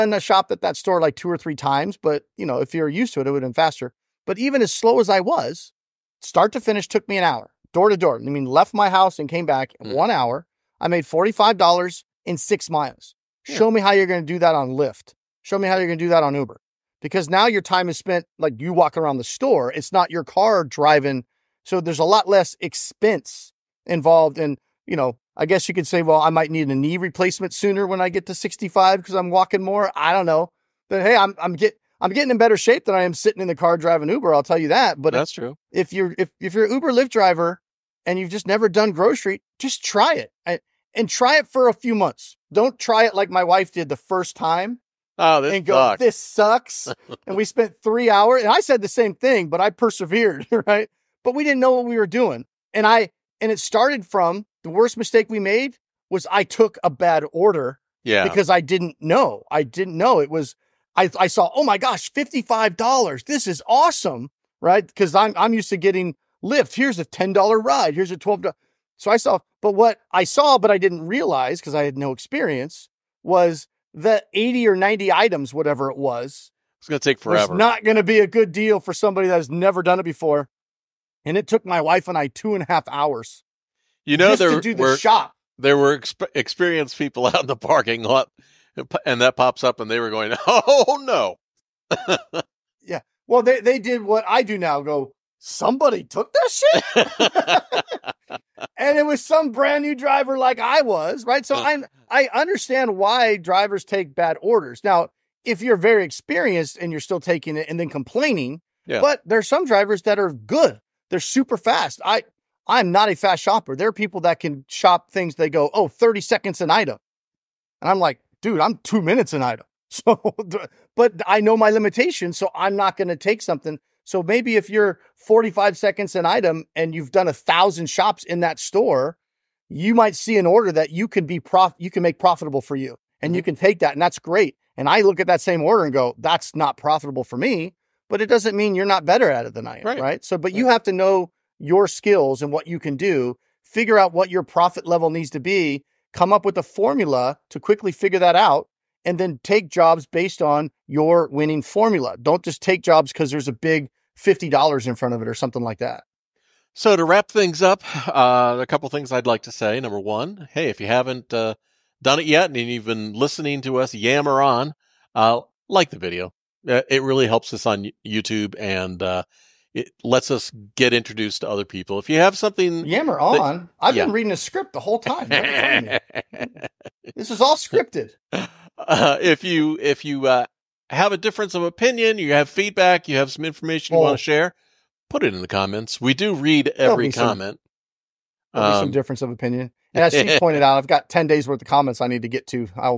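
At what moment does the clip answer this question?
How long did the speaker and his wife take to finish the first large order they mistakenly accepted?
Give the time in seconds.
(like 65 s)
82 s.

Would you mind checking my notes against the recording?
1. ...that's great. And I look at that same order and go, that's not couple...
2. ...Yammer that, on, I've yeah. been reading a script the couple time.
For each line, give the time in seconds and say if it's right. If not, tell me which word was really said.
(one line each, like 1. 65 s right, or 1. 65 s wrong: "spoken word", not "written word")
1. 134 s wrong: "profitable", not "couple"
2. 172 s wrong: "whole", not "couple".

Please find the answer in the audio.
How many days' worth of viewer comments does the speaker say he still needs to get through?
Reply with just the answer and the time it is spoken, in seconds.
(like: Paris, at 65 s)
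10 days, at 191 s.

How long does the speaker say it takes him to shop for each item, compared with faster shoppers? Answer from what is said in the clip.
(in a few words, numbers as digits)
2 minutes.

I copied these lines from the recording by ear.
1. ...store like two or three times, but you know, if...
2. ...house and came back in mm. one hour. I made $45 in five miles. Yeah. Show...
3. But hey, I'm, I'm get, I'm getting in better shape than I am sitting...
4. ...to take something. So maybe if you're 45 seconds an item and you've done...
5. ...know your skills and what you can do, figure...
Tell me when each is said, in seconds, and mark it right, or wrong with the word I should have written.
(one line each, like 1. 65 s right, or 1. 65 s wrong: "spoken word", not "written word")
1. 0 s right
2. 8 s wrong: "six", not "five"
3. 30 s right
4. 123 s right
5. 140 s right.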